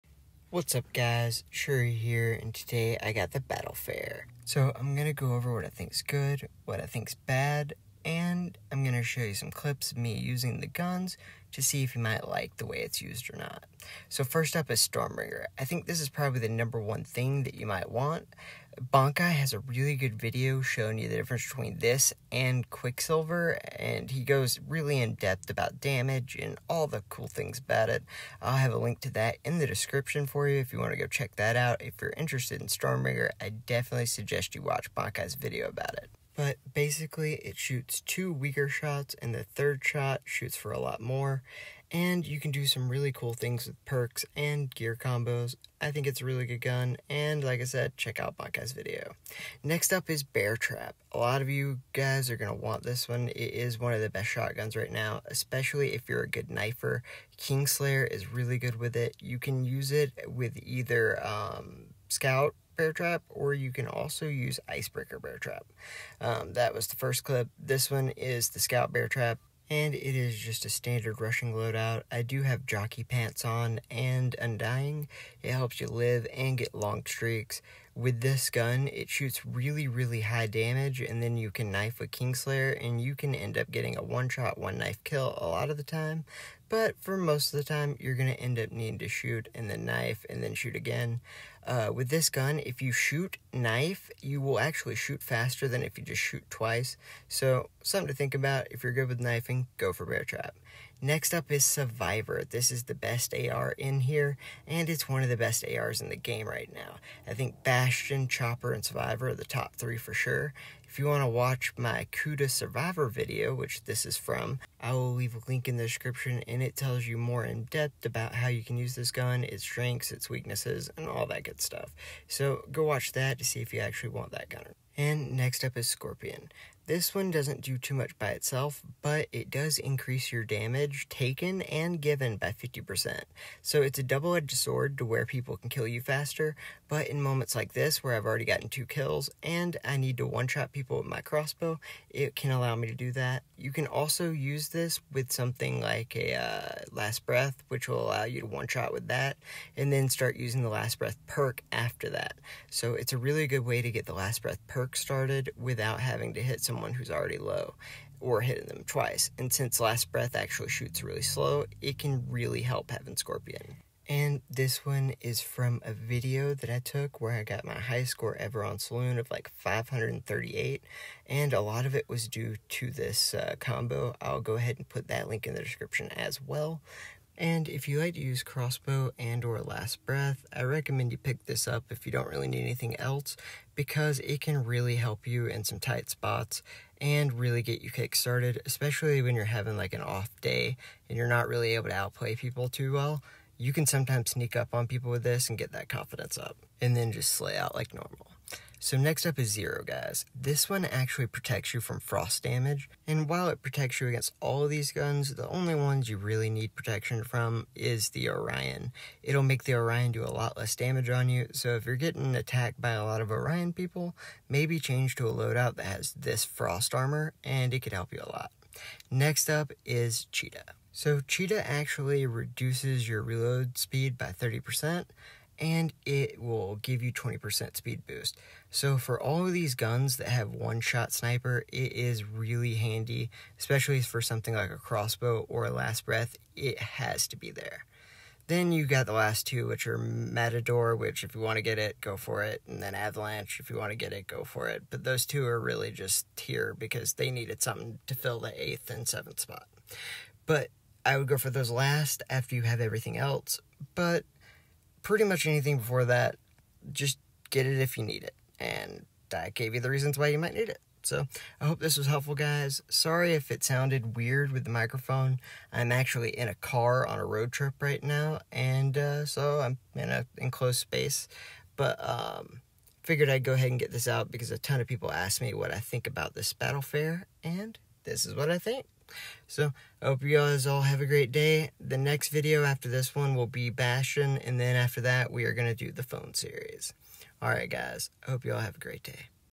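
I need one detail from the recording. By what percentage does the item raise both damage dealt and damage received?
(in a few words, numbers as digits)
50%.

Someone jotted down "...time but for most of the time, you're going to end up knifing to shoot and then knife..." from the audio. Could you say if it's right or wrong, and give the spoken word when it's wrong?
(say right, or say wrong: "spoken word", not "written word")
wrong: "needing", not "knifing".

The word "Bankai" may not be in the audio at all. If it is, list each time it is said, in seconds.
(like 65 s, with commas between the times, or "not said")
18 s, 34 s.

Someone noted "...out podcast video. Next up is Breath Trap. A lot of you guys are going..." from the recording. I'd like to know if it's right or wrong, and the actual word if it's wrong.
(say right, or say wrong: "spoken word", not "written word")
wrong: "Bear", not "Breath".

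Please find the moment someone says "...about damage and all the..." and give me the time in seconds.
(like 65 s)
25 s.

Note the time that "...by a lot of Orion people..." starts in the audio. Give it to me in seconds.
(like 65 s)
212 s.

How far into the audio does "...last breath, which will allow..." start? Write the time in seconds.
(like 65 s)
146 s.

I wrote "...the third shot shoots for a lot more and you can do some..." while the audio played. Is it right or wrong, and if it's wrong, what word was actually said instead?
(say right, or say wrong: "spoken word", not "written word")
right.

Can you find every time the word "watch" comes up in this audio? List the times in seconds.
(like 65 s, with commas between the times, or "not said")
34 s, 111 s, 122 s.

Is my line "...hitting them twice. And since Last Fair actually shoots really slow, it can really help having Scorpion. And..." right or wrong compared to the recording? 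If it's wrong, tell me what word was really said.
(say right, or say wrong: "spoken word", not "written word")
wrong: "Breath", not "Fair".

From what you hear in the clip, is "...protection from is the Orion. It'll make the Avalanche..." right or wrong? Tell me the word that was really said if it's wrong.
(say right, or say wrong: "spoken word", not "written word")
wrong: "Orion", not "Avalanche".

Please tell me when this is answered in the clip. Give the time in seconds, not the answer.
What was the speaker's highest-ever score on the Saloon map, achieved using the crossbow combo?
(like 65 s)
169 s.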